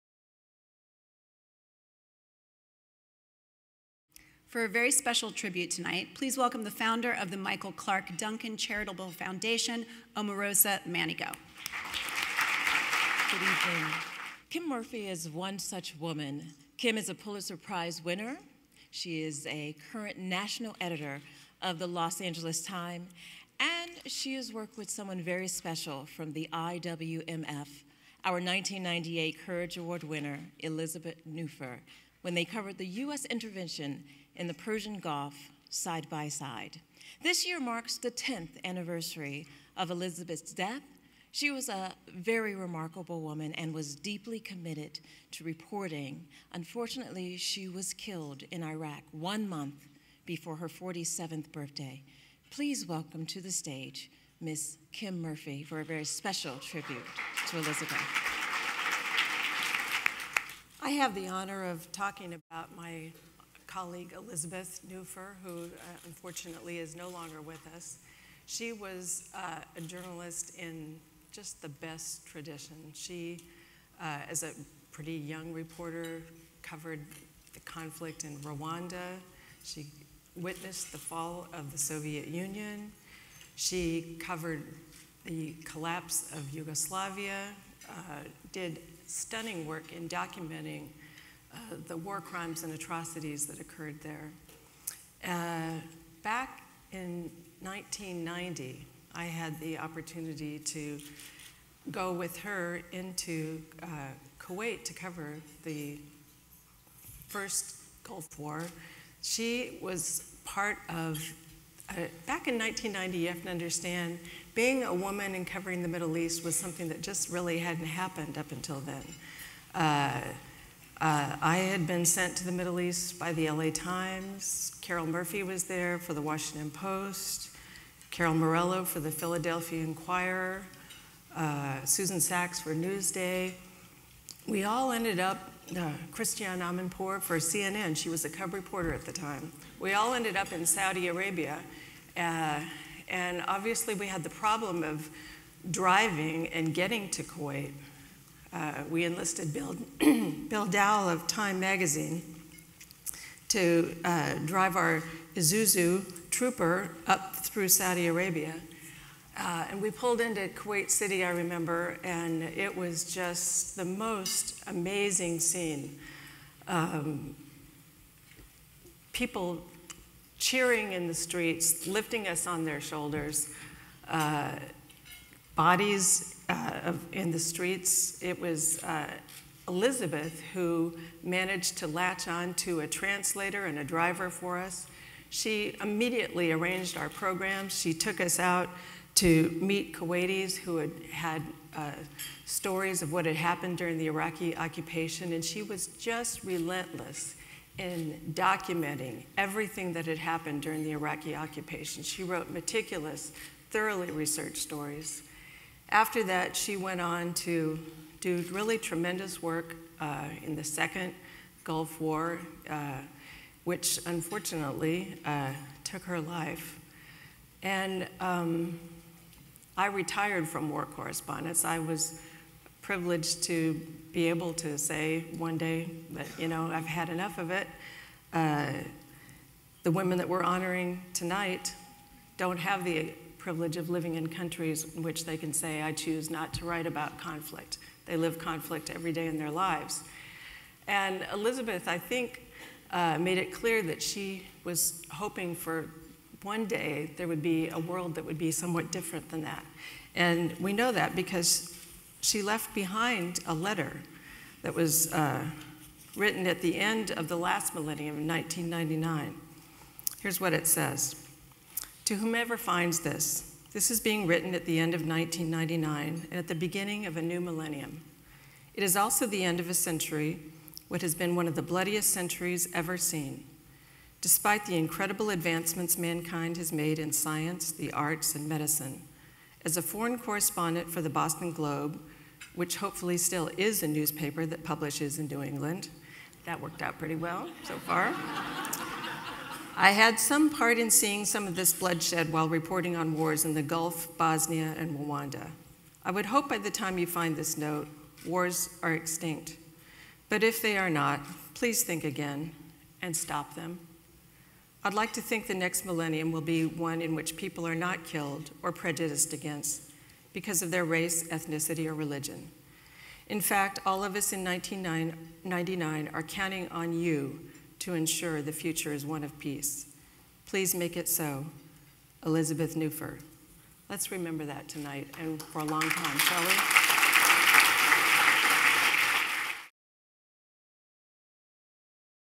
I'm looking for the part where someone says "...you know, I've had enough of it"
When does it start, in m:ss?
3:46.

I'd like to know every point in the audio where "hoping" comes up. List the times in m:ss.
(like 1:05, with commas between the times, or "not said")
4:05.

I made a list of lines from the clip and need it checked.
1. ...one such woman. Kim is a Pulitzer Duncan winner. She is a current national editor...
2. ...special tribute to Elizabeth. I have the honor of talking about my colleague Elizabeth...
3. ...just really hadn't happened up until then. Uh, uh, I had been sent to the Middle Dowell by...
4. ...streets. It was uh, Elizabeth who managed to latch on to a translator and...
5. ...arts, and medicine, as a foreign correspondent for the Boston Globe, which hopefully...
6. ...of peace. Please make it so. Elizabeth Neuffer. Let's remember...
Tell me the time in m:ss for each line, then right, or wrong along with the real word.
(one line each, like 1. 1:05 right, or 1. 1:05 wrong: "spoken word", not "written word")
1. 0:15 wrong: "Prize", not "Duncan"
2. 0:56 right
3. 1:57 wrong: "East", not "Dowell"
4. 2:57 right
5. 4:37 right
6. 5:19 right.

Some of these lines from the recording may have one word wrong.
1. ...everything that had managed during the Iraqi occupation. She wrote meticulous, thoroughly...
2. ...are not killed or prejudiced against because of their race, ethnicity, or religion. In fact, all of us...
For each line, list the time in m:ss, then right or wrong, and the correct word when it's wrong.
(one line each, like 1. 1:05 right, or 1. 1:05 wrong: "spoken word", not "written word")
1. 3:19 wrong: "happened", not "managed"
2. 5:07 right.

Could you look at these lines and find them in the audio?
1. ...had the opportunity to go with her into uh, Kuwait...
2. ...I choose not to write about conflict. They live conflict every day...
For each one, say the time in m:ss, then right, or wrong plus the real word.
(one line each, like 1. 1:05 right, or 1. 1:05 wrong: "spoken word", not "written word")
1. 1:39 right
2. 3:55 right.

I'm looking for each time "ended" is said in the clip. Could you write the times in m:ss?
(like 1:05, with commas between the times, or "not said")
2:14, 2:20.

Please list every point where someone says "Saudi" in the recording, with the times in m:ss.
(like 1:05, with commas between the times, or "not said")
2:20, 2:37.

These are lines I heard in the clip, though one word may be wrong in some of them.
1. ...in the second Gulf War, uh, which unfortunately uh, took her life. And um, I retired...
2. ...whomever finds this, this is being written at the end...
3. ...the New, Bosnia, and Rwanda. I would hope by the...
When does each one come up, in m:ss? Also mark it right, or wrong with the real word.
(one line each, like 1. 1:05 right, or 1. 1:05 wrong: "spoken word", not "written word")
1. 3:30 right
2. 4:22 right
3. 4:53 wrong: "Gulf", not "New".